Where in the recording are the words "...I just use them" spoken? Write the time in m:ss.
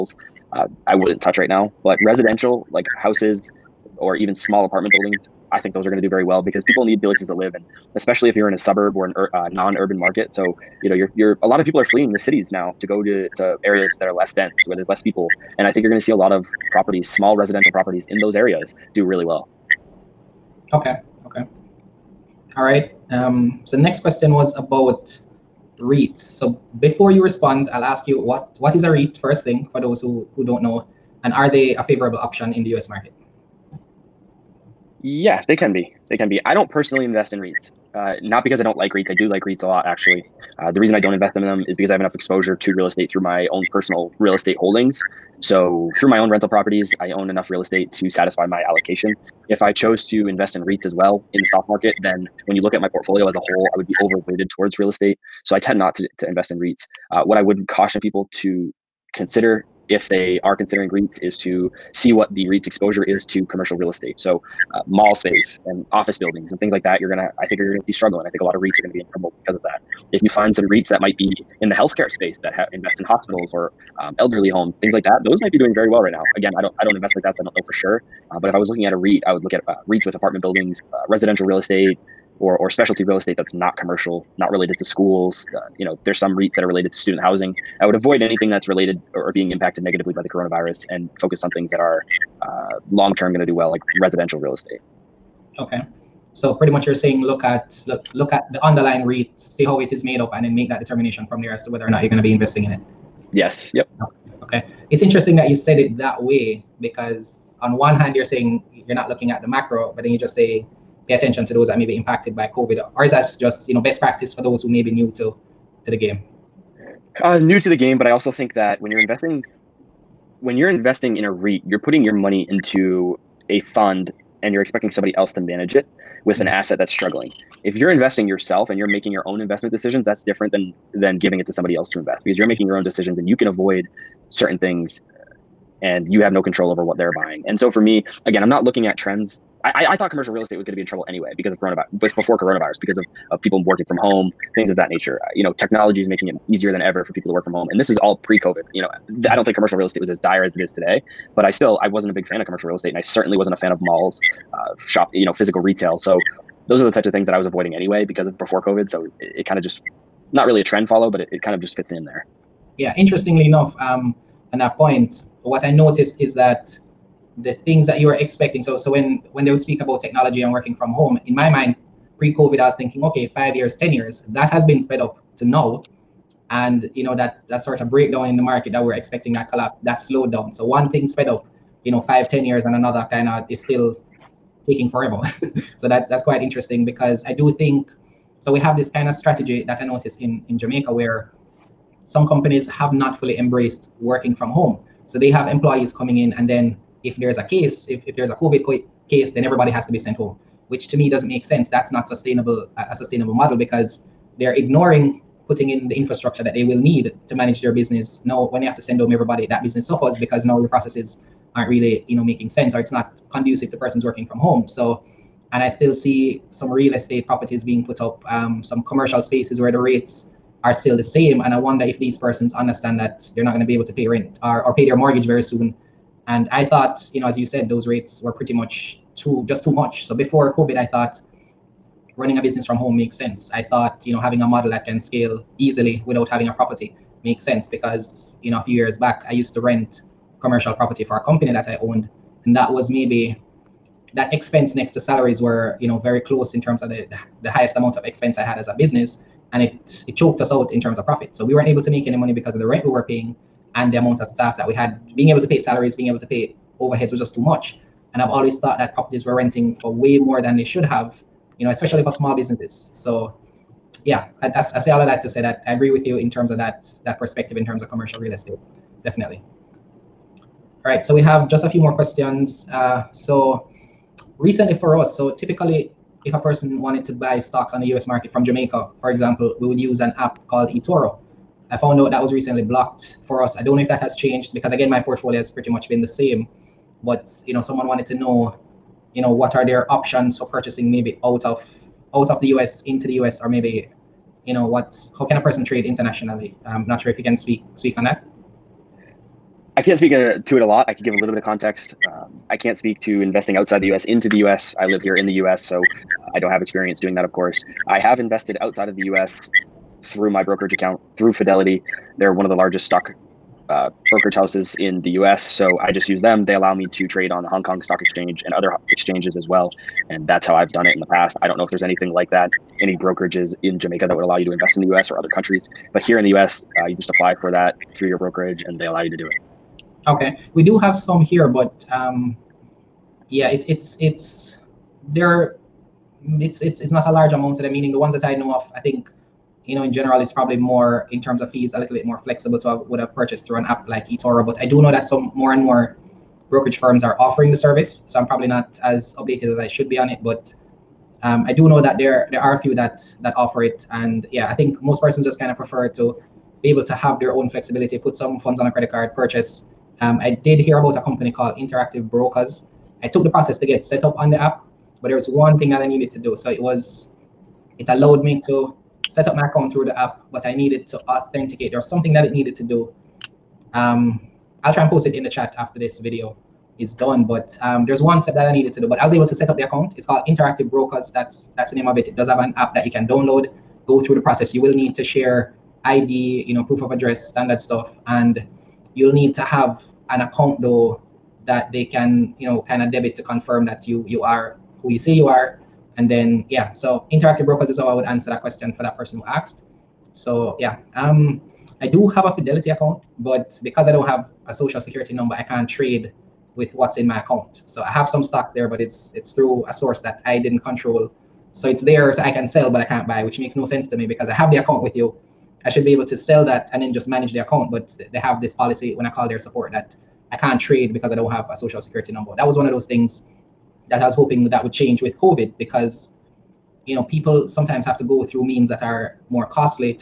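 5:15.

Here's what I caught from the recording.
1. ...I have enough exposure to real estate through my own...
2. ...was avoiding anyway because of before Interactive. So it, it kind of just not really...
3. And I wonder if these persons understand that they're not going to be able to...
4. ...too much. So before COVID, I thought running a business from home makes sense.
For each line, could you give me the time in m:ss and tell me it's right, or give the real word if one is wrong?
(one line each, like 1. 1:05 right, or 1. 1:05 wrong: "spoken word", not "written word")
1. 0:41 right
2. 2:37 wrong: "COVID", not "Interactive"
3. 3:41 right
4. 3:49 right.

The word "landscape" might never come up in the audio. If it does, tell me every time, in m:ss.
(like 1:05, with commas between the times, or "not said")
not said.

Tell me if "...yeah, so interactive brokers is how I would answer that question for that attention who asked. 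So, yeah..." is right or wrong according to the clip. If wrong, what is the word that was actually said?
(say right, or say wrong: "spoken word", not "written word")
wrong: "person", not "attention".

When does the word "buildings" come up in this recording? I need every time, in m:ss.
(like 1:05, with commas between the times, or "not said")
0:04, 1:06, 1:20.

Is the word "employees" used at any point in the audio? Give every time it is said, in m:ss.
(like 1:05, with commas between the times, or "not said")
3:15.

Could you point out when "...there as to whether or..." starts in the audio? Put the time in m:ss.
1:41.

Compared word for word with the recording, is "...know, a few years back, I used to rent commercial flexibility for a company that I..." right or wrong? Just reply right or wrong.
wrong.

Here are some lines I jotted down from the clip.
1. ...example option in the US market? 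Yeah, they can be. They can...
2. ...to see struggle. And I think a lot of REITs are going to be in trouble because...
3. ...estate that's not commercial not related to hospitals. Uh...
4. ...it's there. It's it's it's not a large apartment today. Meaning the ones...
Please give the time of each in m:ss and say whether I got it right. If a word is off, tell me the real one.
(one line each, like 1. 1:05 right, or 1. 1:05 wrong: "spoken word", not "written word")
1. 0:31 wrong: "favorable", not "example"
2. 1:07 right
3. 1:23 wrong: "schools", not "hospitals"
4. 5:33 wrong: "amount", not "apartment".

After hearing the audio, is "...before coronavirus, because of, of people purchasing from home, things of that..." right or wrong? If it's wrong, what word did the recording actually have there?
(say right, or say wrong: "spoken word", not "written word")
wrong: "working", not "purchasing".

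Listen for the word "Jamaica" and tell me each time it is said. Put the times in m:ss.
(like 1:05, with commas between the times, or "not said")
3:10, 4:38, 5:23.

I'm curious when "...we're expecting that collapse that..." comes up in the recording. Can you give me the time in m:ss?
2:58.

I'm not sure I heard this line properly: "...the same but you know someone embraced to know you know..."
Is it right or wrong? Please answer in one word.
wrong.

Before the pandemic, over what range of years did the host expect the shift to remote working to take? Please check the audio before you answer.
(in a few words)
5 to 10 years.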